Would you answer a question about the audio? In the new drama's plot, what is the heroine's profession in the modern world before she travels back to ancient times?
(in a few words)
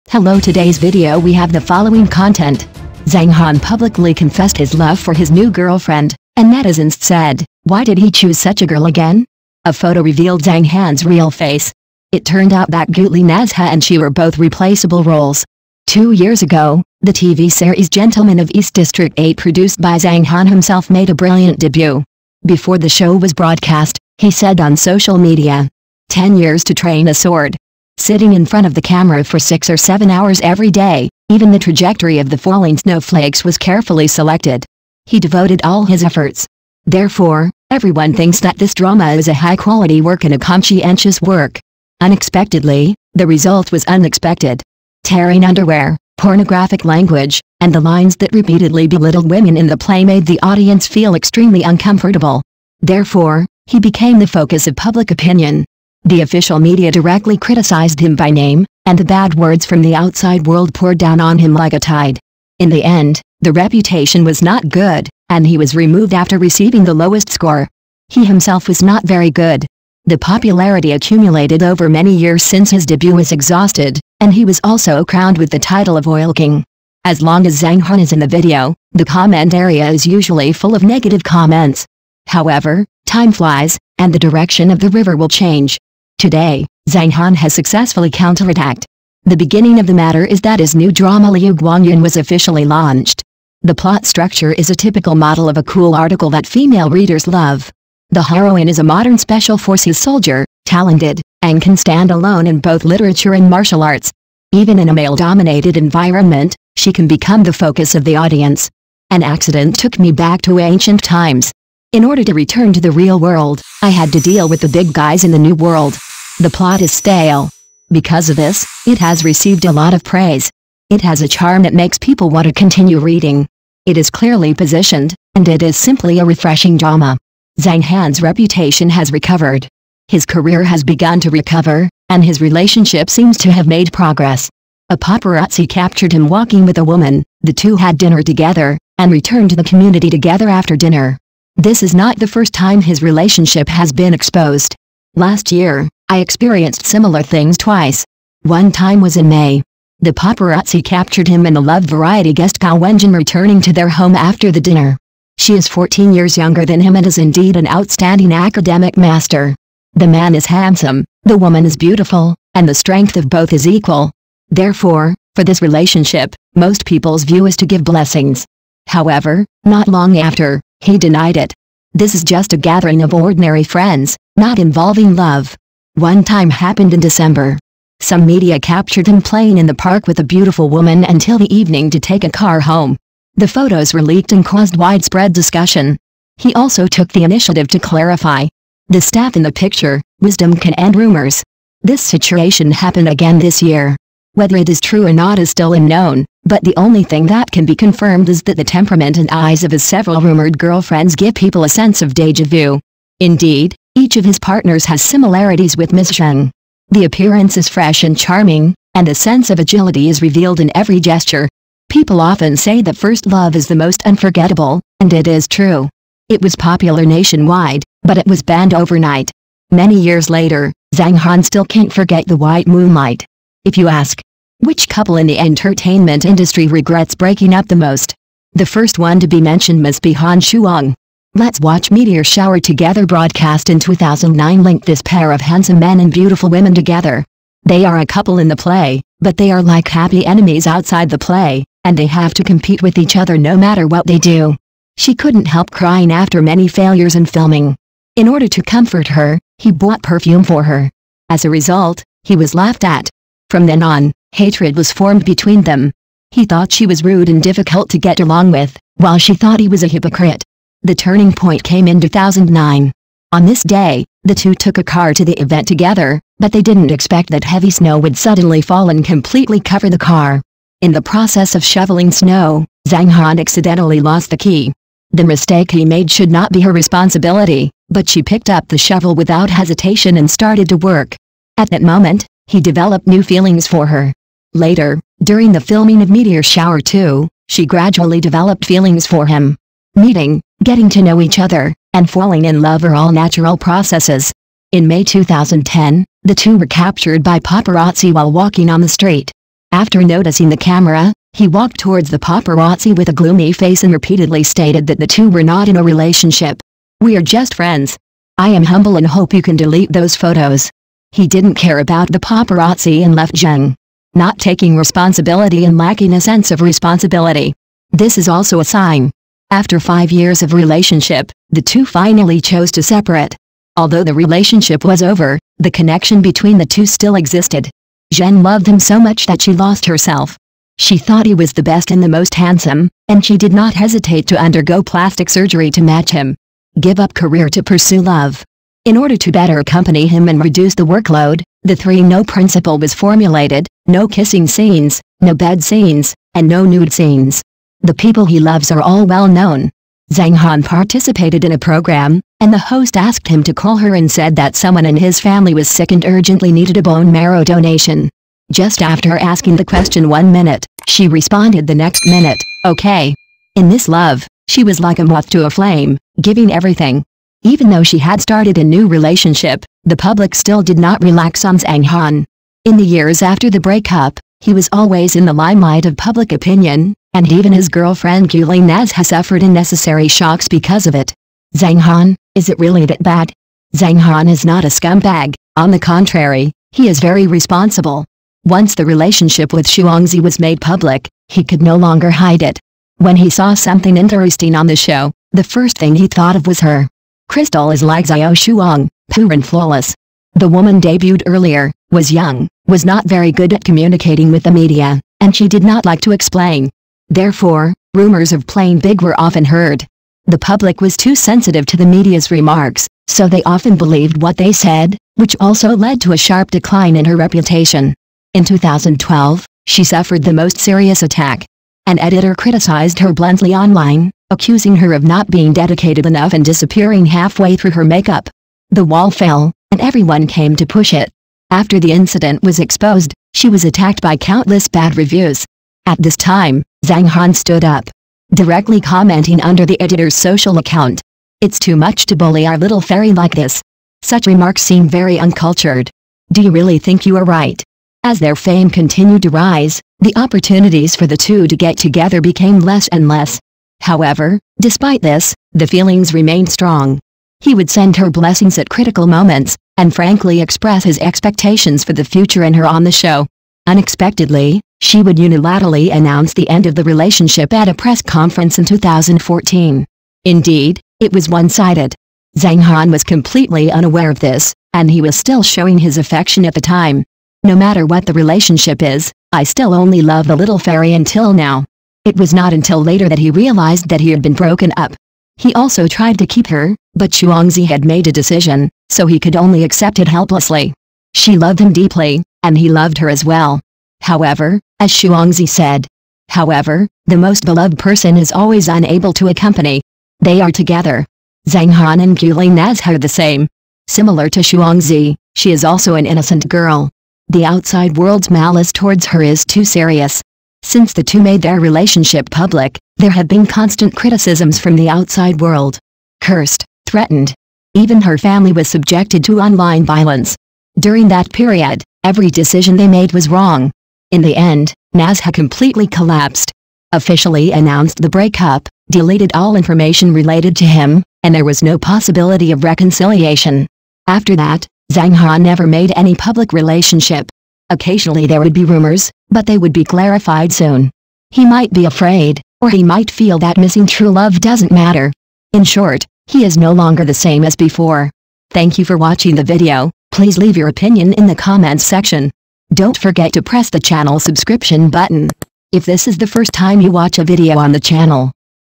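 special forces soldier.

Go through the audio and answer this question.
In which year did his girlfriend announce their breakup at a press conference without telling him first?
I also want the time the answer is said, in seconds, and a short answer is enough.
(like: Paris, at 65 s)
2014, at 468 s.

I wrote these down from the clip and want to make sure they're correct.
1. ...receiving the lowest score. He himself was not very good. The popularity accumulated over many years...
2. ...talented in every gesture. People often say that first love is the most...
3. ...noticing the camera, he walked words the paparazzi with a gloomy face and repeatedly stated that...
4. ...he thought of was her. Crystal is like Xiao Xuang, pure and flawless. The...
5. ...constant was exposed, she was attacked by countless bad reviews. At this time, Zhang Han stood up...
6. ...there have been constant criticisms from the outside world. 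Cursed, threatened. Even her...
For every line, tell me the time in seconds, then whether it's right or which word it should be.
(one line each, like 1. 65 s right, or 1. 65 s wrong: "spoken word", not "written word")
1. 66 s right
2. 210 s wrong: "revealed", not "talented"
3. 300 s wrong: "towards", not "words"
4. 395 s right
5. 431 s wrong: "incident", not "constant"
6. 512 s right.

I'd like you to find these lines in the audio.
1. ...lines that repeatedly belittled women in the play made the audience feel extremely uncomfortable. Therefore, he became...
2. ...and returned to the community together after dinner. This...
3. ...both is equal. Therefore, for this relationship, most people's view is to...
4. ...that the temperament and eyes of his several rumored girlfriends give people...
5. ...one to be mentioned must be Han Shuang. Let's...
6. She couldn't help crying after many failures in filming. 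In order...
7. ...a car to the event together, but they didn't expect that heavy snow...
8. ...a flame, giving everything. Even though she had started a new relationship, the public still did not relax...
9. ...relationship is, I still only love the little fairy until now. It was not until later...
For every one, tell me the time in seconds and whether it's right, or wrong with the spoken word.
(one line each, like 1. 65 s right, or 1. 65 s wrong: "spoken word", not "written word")
1. 47 s right
2. 138 s right
3. 163 s right
4. 198 s right
5. 228 s right
6. 244 s right
7. 264 s right
8. 365 s right
9. 478 s right.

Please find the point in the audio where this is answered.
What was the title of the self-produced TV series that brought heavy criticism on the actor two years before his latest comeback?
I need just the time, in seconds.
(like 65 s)
17 s.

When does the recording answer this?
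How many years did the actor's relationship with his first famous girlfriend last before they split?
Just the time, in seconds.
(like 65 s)
319 s.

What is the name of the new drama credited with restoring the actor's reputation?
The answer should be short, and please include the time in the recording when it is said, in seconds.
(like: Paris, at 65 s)
Liu Guangyin, at 91 s.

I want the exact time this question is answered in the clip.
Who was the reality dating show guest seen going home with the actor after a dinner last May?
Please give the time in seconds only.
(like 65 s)
152 s.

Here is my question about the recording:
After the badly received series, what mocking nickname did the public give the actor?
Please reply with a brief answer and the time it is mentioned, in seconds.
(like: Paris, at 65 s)
Oil King, at 76 s.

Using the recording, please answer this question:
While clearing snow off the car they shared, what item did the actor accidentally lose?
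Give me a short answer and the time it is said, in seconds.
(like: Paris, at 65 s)
the key, at 274 s.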